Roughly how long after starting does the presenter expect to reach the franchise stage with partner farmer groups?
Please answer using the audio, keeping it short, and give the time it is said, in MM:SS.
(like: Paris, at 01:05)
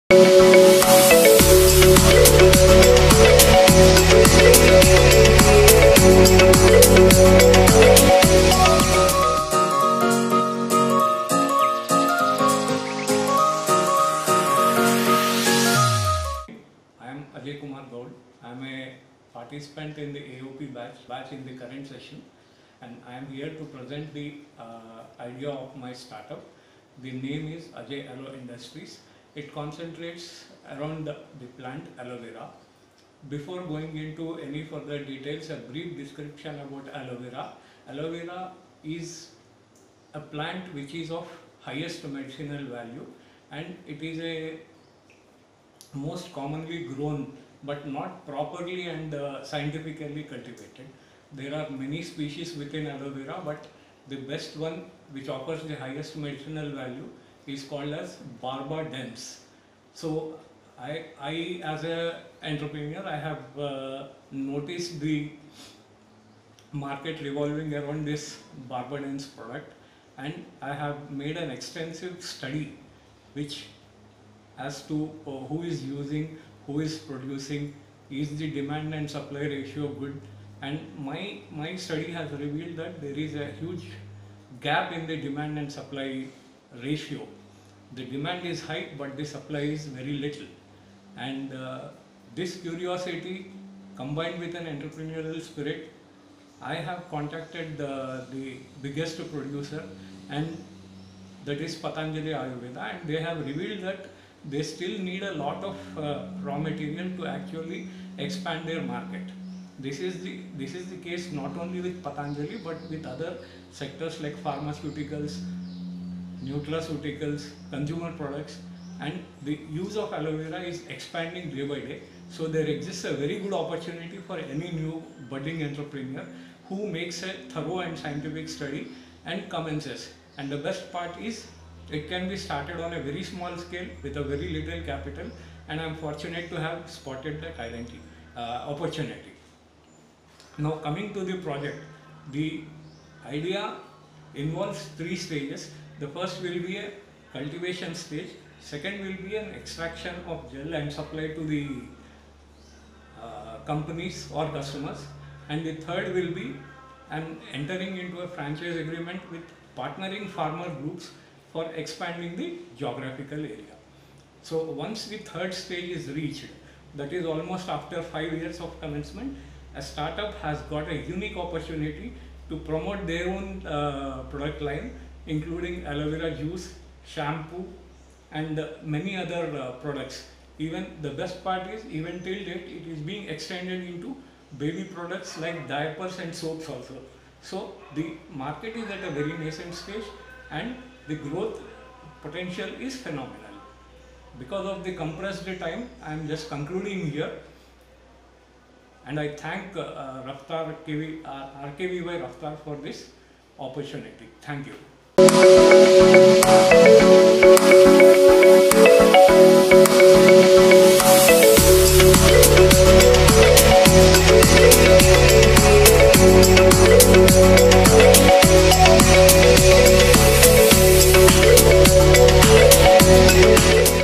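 5 years, at 02:48.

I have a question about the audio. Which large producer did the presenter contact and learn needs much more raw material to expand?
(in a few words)
Patanjali Ayurveda.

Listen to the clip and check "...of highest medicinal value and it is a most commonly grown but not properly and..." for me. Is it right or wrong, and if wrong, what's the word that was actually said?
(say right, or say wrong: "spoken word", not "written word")
right.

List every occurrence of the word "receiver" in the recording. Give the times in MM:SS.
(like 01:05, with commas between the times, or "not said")
not said.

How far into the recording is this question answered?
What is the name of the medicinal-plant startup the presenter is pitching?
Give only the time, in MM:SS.
00:27.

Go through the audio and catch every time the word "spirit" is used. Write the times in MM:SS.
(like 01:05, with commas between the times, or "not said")
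01:35.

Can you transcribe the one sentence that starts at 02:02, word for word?
So there exists a very good opportunity for any new budding entrepreneur who makes a thorough and scientific study and commences.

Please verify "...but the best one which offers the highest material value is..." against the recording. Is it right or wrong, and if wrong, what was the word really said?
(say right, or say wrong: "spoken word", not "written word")
wrong: "medicinal", not "material".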